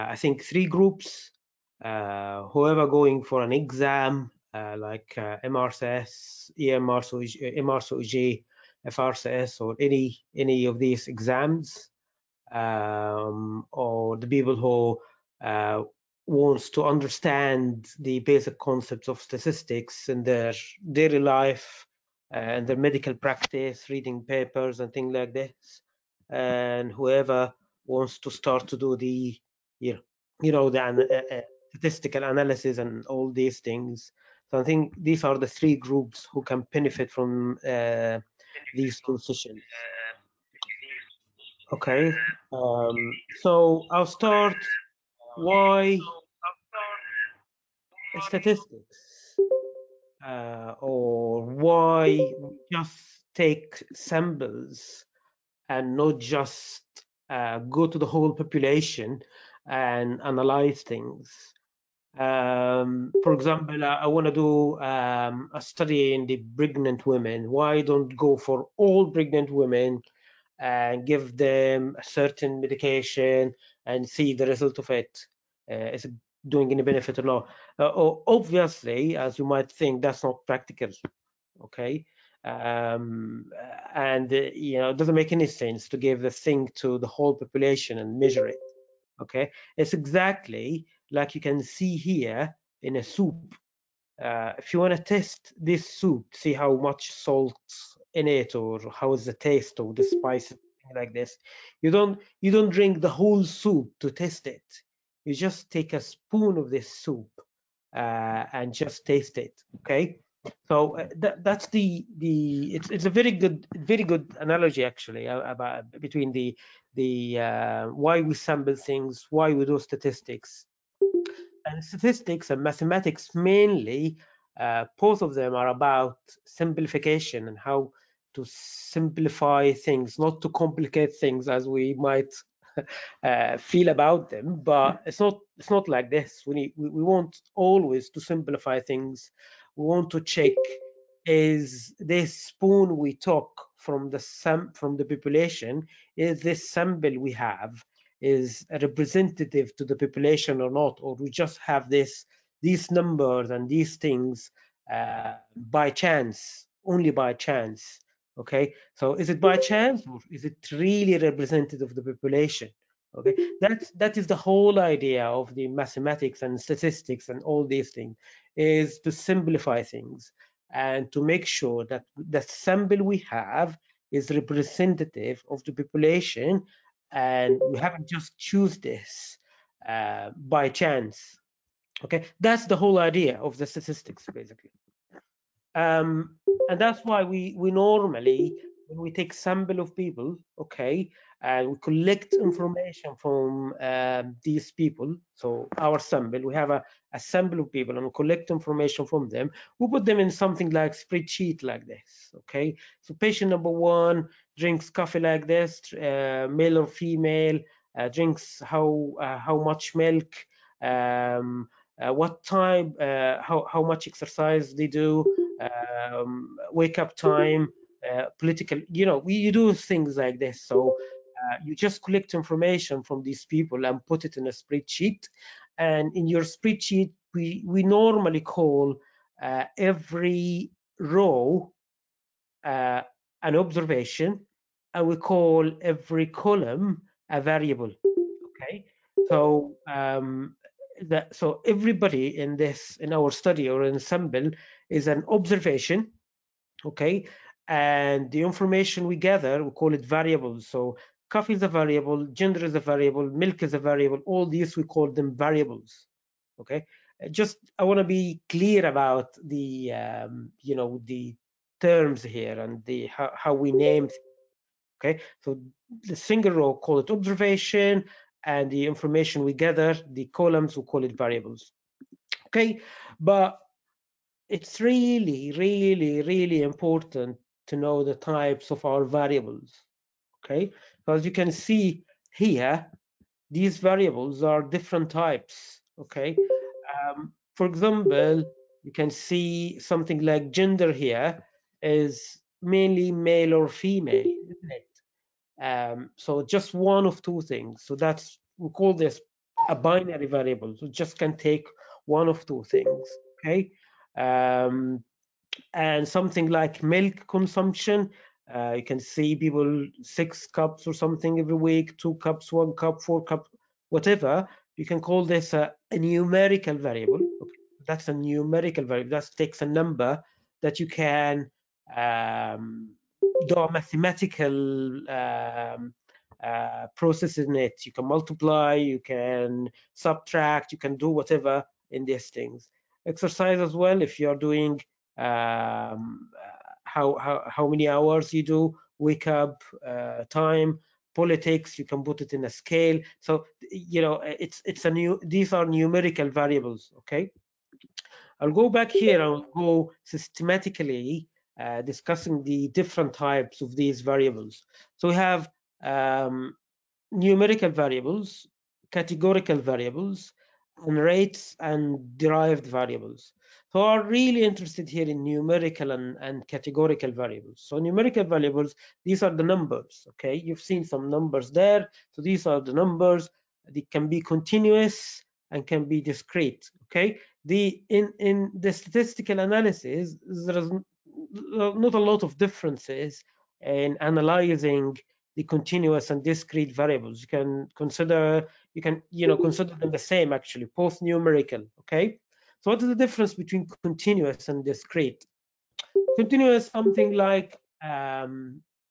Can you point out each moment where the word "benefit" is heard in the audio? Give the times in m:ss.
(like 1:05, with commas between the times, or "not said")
0:36, 1:16.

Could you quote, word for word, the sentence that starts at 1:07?
Why don't go for all pregnant women and give them a certain medication and see the result of it?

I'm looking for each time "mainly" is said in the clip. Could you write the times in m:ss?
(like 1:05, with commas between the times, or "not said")
2:03, 4:52.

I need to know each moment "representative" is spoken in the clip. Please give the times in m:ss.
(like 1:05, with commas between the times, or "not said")
2:28, 2:41, 2:54.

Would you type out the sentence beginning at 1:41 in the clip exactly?
You don't you don't drink the whole soup to test it.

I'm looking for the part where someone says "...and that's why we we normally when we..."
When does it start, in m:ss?
3:06.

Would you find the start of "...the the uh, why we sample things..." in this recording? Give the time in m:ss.
1:56.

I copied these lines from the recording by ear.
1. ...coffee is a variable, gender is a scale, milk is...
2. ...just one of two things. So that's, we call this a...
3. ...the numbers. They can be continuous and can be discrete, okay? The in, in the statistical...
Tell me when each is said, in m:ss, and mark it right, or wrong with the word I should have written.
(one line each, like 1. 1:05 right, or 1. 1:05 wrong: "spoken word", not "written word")
1. 4:11 wrong: "variable", not "scale"
2. 4:56 right
3. 6:12 right.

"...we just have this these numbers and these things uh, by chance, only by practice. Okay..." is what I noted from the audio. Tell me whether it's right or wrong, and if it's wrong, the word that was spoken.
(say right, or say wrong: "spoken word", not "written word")
wrong: "chance", not "practice".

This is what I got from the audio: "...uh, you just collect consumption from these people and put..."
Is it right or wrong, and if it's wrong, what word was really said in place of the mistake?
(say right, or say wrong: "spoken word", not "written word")
wrong: "information", not "consumption".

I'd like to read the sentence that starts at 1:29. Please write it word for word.
Okay, it's exactly like you can see here in a soup.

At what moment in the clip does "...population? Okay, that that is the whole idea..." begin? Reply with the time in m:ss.
2:42.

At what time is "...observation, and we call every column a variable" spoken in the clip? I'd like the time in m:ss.
3:53.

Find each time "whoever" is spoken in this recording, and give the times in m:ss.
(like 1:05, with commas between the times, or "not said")
0:02, 0:26.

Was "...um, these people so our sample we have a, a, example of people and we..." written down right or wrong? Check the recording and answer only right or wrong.
wrong.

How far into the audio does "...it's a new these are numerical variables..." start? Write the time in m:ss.
5:44.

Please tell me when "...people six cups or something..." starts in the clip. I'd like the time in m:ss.
5:09.